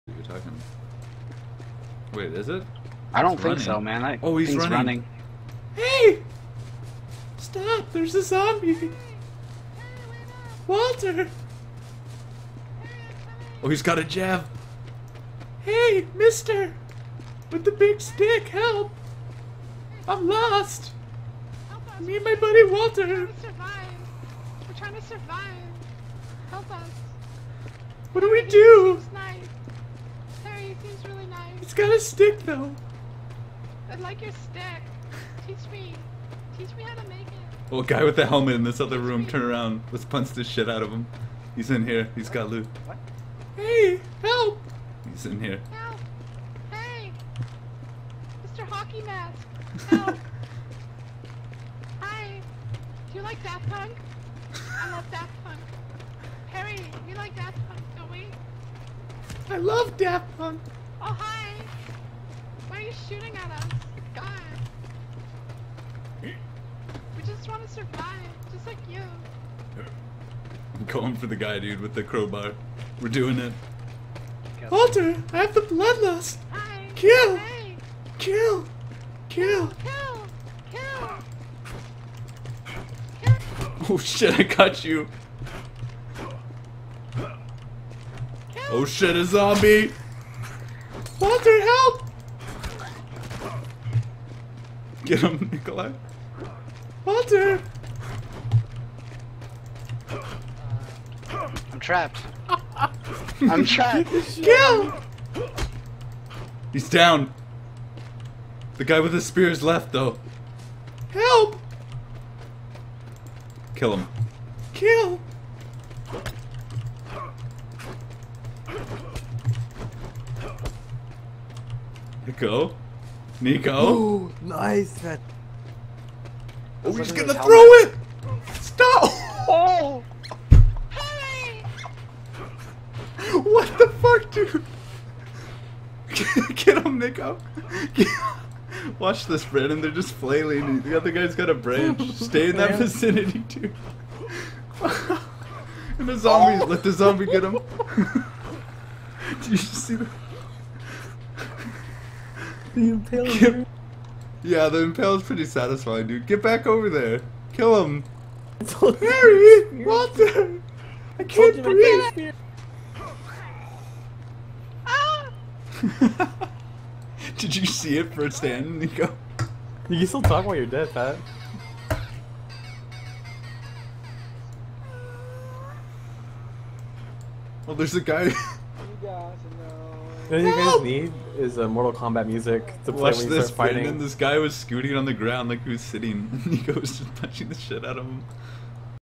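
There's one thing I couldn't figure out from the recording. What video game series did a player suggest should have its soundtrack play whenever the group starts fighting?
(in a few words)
Mortal Kombat.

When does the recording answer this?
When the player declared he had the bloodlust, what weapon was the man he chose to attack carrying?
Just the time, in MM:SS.
01:12.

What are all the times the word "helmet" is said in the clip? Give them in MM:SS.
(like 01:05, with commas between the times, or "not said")
00:38, 02:07.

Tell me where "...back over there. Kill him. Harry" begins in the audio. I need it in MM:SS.
02:36.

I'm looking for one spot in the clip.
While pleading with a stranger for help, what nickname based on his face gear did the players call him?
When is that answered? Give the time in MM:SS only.
00:48.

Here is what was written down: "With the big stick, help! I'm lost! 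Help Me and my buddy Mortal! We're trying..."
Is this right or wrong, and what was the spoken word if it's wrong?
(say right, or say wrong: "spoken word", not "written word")
wrong: "Walter", not "Mortal".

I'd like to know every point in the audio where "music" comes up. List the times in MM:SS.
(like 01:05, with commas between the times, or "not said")
03:02.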